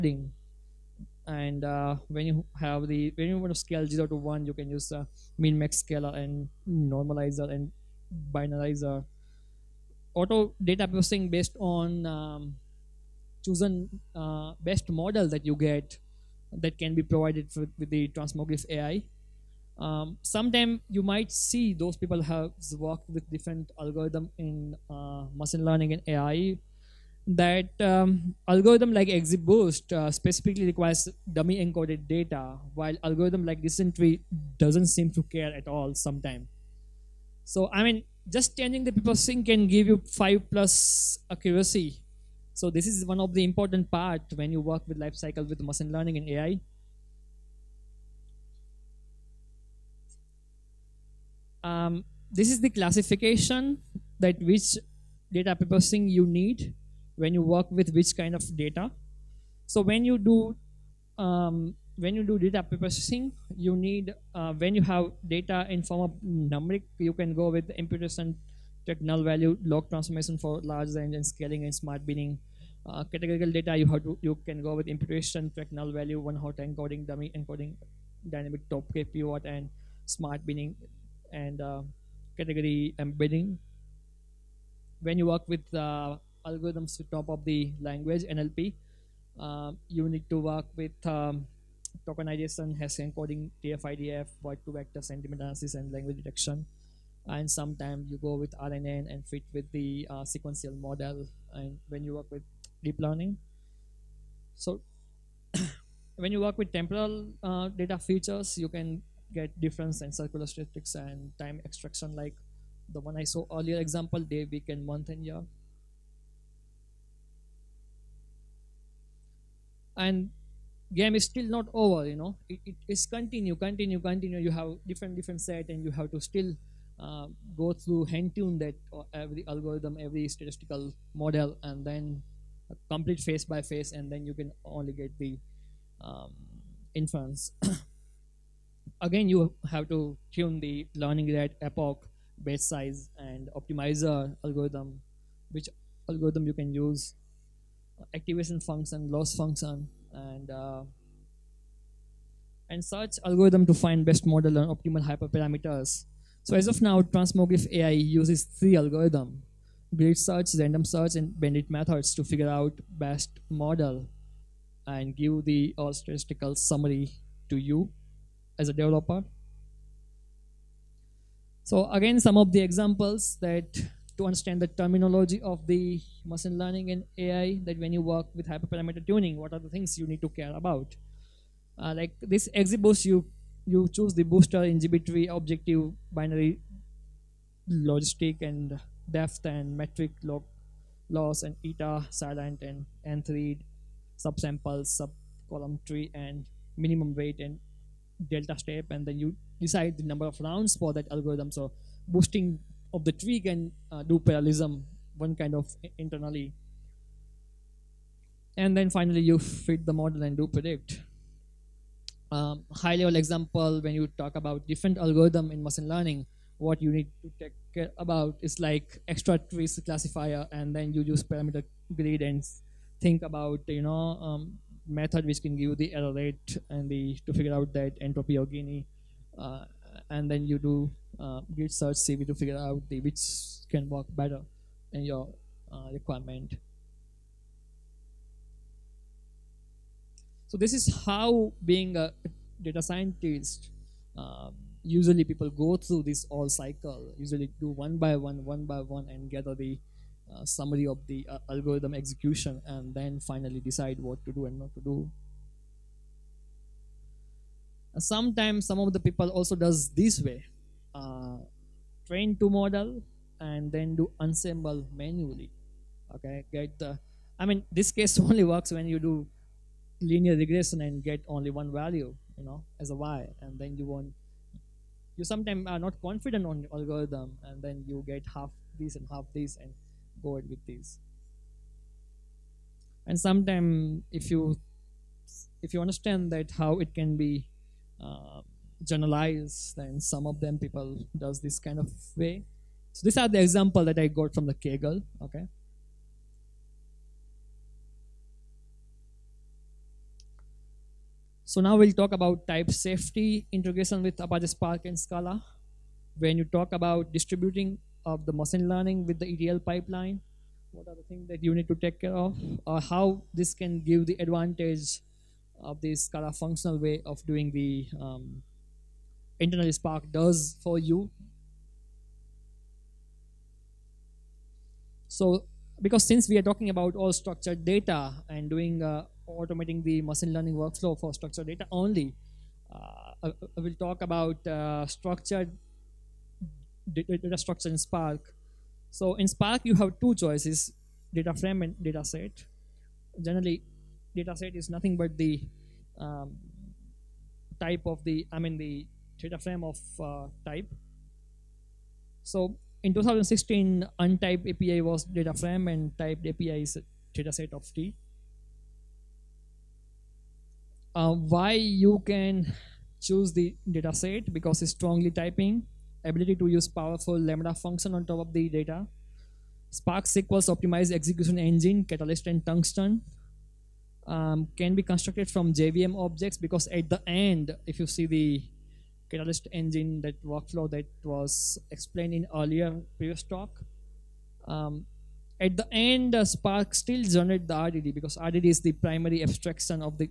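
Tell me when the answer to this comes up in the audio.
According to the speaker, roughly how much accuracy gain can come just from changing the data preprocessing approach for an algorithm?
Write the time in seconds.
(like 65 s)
40 s.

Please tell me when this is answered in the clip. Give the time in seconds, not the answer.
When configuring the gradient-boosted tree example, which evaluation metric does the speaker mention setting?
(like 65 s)
190 s.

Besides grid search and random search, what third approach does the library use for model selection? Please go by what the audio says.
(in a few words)
bandit methods.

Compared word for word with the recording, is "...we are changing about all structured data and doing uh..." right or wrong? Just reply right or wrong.
wrong.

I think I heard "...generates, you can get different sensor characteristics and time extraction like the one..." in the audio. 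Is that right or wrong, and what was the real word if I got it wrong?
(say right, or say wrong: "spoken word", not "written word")
wrong: "features", not "generates".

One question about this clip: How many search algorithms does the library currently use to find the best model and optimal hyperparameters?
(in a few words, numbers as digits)
3.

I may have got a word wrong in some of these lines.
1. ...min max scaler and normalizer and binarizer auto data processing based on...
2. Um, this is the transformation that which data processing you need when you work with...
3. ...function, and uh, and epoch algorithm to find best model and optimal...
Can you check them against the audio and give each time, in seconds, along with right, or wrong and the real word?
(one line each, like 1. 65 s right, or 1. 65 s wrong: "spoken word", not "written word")
1. 5 s right
2. 51 s wrong: "classification", not "transformation"
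3. 149 s wrong: "search", not "epoch".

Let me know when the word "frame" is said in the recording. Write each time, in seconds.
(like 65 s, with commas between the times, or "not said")
341 s, 349 s, 355 s.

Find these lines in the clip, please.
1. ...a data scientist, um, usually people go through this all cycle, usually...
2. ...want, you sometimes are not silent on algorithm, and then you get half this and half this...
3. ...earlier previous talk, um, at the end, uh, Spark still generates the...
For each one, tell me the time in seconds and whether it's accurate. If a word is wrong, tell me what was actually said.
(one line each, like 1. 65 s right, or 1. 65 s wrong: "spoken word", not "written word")
1. 241 s right
2. 273 s wrong: "confident", not "silent"
3. 382 s right.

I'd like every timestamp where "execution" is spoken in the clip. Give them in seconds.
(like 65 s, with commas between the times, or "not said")
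251 s, 370 s.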